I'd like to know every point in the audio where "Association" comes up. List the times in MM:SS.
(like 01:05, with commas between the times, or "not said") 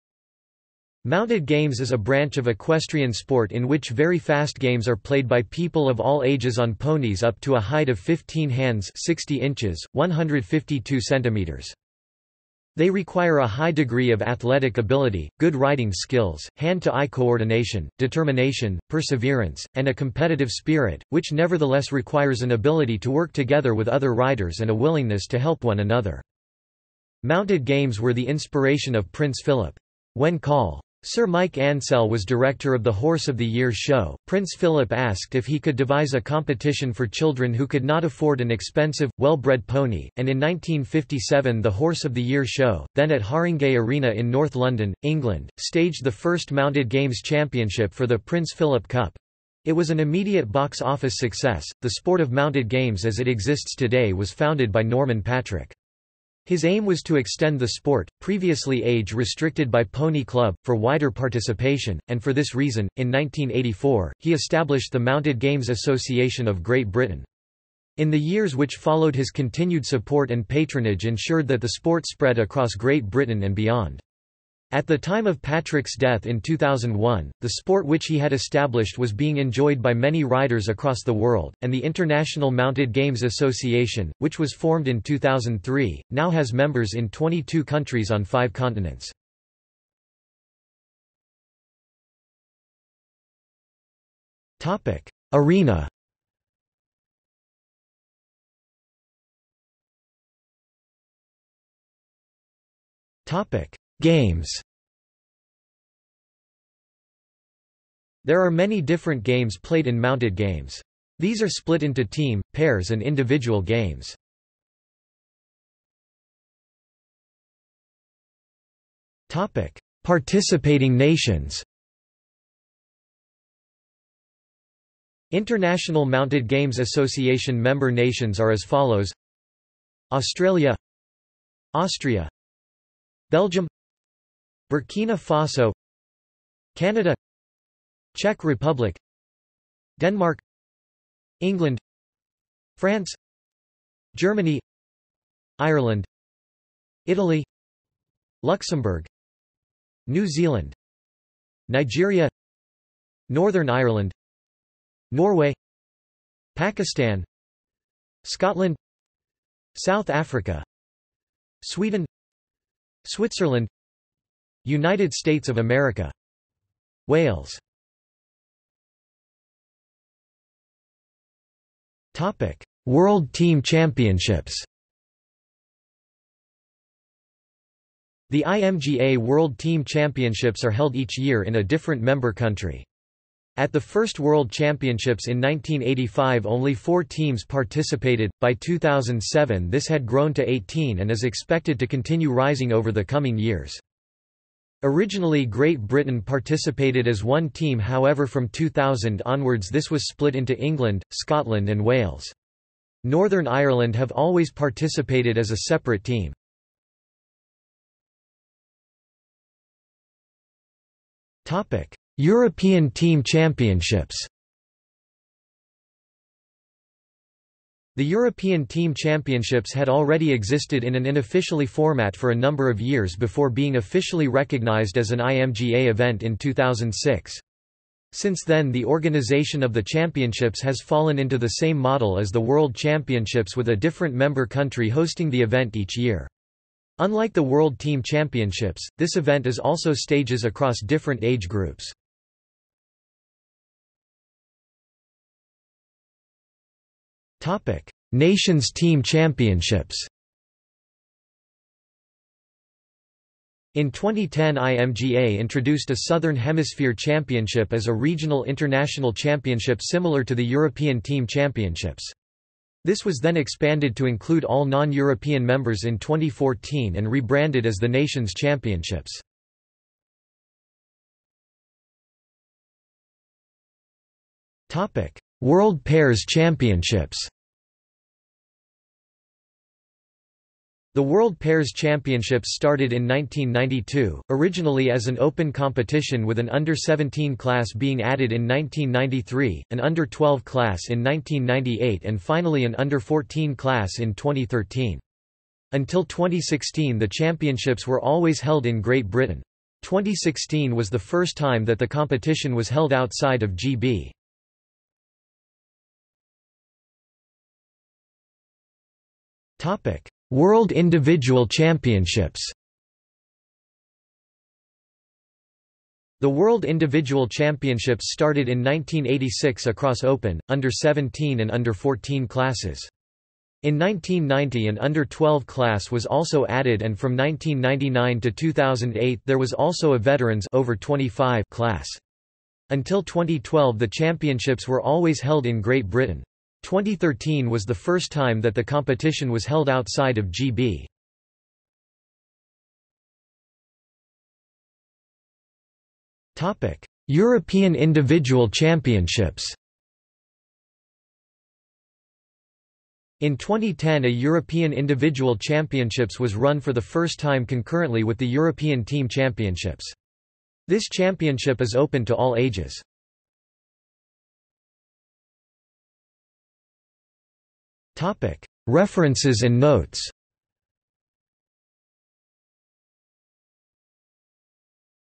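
01:05, 01:23, 02:06.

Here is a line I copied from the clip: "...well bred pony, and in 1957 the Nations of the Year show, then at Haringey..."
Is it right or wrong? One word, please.
wrong.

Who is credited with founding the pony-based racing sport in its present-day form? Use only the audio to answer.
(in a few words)
Norman Patrick.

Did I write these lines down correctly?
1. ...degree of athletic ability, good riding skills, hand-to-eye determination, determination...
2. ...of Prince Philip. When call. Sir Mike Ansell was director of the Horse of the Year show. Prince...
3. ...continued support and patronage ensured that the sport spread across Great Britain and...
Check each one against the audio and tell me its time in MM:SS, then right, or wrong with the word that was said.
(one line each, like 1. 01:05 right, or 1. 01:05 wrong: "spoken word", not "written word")
1. 00:13 wrong: "coordination", not "determination"
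2. 00:28 right
3. 01:09 right.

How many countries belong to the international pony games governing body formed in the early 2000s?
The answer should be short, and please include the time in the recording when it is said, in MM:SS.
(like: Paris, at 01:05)
22, at 01:27.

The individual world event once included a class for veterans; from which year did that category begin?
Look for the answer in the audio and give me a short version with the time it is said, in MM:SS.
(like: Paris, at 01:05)
1999, at 05:27.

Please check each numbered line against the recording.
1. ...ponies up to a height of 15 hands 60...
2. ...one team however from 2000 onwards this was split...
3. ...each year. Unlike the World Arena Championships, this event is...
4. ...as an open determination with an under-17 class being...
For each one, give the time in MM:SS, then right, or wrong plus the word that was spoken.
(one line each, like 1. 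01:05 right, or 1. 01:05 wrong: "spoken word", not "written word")
1. 00:06 right
2. 03:17 right
3. 03:55 wrong: "Team", not "Arena"
4. 04:44 wrong: "competition", not "determination".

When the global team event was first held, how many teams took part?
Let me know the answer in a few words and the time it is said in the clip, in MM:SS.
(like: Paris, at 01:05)
four, at 03:06.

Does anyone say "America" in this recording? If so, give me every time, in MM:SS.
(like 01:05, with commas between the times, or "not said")
02:45.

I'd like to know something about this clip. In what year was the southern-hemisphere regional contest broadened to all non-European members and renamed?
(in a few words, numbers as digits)
2014.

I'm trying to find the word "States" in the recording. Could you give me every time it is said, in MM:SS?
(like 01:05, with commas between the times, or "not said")
02:45.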